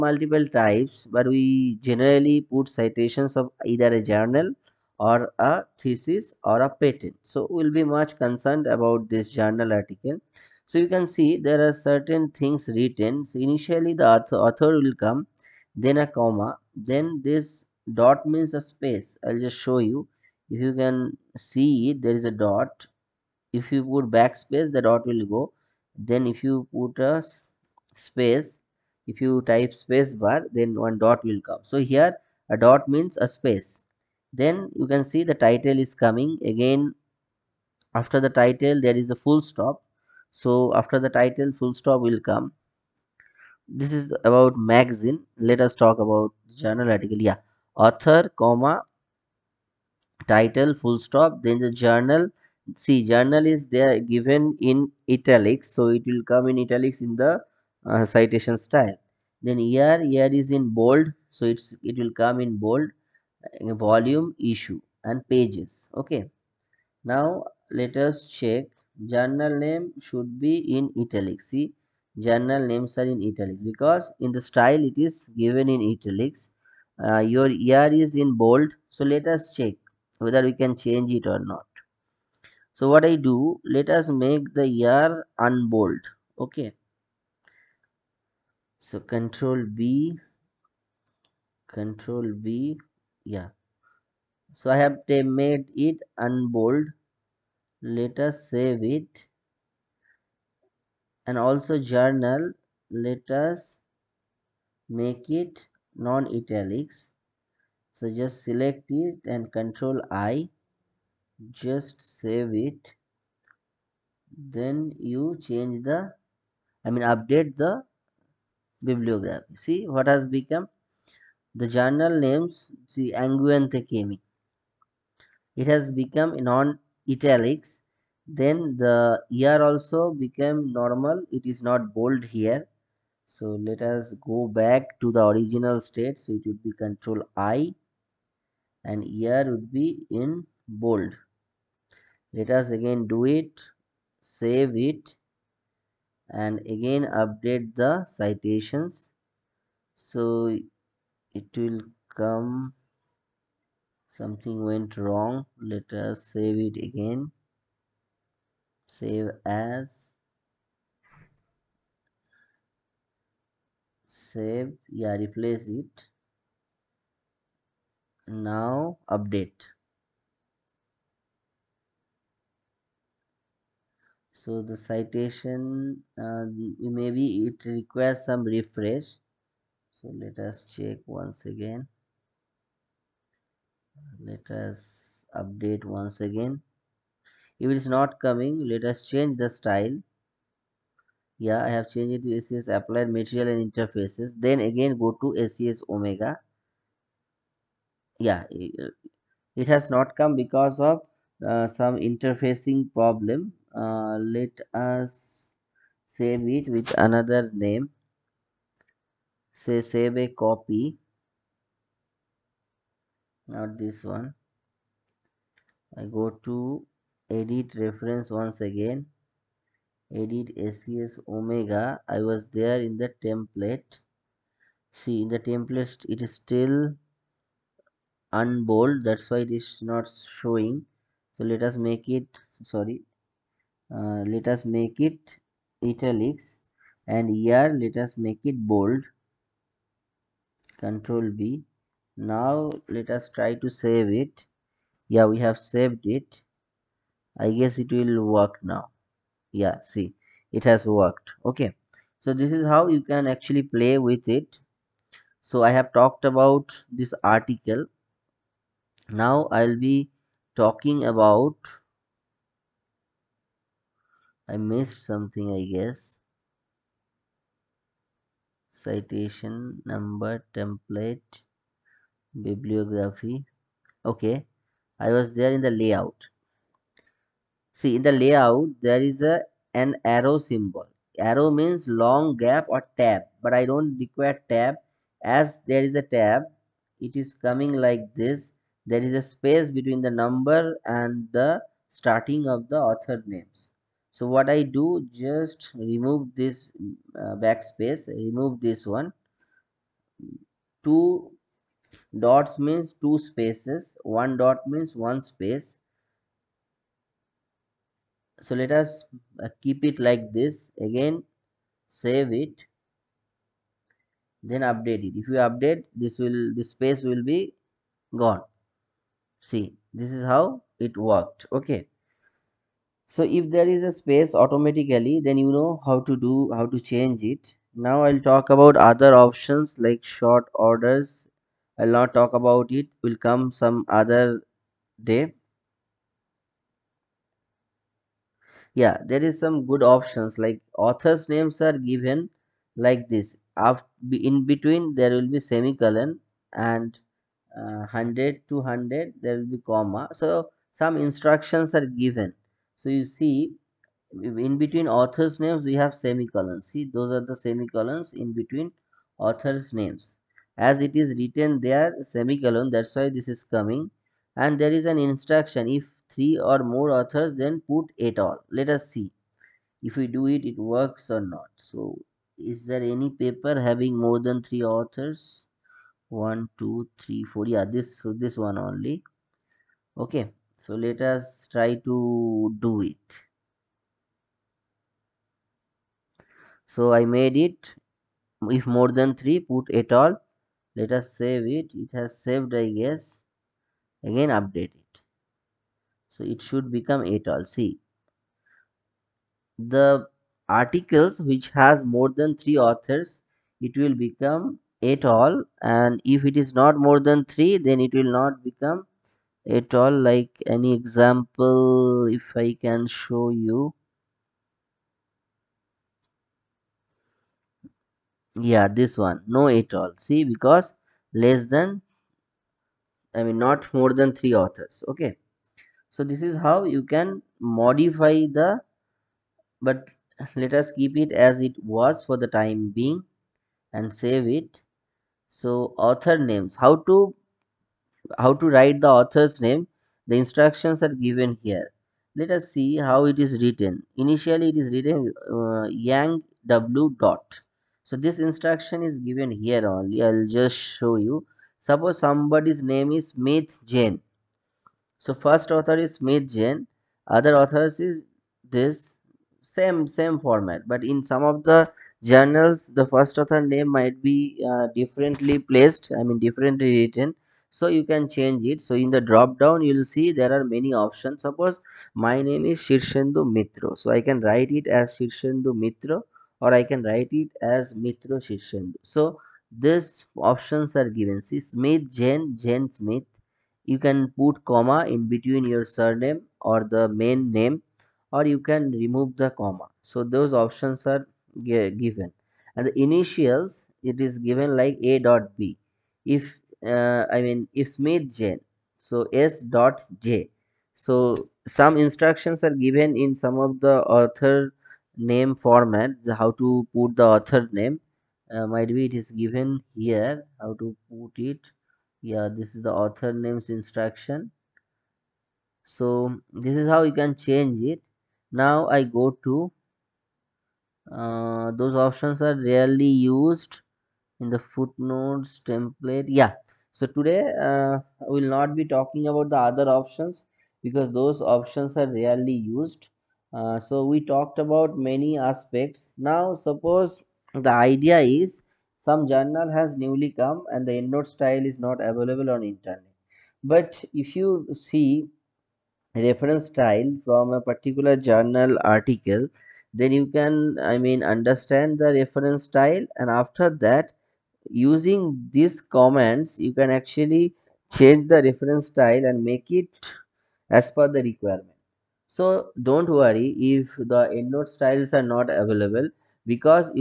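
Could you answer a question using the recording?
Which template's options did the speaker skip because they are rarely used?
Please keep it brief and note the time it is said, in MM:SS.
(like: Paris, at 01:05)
footnotes, at 08:44.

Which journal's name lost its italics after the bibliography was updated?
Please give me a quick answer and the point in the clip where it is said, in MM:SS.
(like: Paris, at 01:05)
Angewandte Chemie, at 02:03.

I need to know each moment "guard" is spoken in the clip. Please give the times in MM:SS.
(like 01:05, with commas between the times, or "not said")
not said.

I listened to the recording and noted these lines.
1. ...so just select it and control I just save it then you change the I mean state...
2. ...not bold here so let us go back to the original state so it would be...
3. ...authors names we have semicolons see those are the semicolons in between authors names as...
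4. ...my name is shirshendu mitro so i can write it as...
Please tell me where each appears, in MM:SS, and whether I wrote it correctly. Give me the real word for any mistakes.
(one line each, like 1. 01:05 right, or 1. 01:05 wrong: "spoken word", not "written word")
1. 01:48 wrong: "update", not "state"
2. 02:11 right
3. 05:54 right
4. 07:52 right.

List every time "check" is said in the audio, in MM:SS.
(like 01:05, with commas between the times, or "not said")
01:08, 01:19, 03:00.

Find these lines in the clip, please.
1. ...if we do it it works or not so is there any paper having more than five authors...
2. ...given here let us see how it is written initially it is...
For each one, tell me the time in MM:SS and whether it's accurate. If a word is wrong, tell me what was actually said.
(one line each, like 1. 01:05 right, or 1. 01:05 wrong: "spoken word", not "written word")
1. 06:09 wrong: "three", not "five"
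2. 07:21 right.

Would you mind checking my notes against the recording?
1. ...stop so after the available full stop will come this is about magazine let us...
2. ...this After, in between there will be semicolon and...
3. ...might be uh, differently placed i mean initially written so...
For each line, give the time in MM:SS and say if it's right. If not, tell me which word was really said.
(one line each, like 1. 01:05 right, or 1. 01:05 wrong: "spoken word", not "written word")
1. 00:39 wrong: "title", not "available"
2. 05:43 right
3. 07:43 wrong: "differently", not "initially".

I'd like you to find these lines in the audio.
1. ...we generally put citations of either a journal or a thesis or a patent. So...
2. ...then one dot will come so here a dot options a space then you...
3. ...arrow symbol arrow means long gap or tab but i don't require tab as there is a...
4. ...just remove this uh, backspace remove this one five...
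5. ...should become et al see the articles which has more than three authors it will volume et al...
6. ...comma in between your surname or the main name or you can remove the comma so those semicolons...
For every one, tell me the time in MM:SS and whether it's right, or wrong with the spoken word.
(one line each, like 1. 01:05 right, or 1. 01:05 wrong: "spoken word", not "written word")
1. 00:01 right
2. 00:30 wrong: "means", not "options"
3. 04:40 right
4. 04:55 wrong: "two", not "five"
5. 06:36 wrong: "become", not "volume"
6. 08:04 wrong: "options", not "semicolons".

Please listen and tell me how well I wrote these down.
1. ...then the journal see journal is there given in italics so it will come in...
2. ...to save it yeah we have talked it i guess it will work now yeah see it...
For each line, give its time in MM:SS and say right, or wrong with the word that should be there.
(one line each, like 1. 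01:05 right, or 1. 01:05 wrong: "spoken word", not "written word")
1. 00:51 right
2. 04:03 wrong: "saved", not "talked".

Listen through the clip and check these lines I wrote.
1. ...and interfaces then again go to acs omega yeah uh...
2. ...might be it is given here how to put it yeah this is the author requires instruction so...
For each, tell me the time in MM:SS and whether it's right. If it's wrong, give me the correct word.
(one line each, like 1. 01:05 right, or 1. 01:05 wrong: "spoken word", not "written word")
1. 03:13 right
2. 08:28 wrong: "names", not "requires".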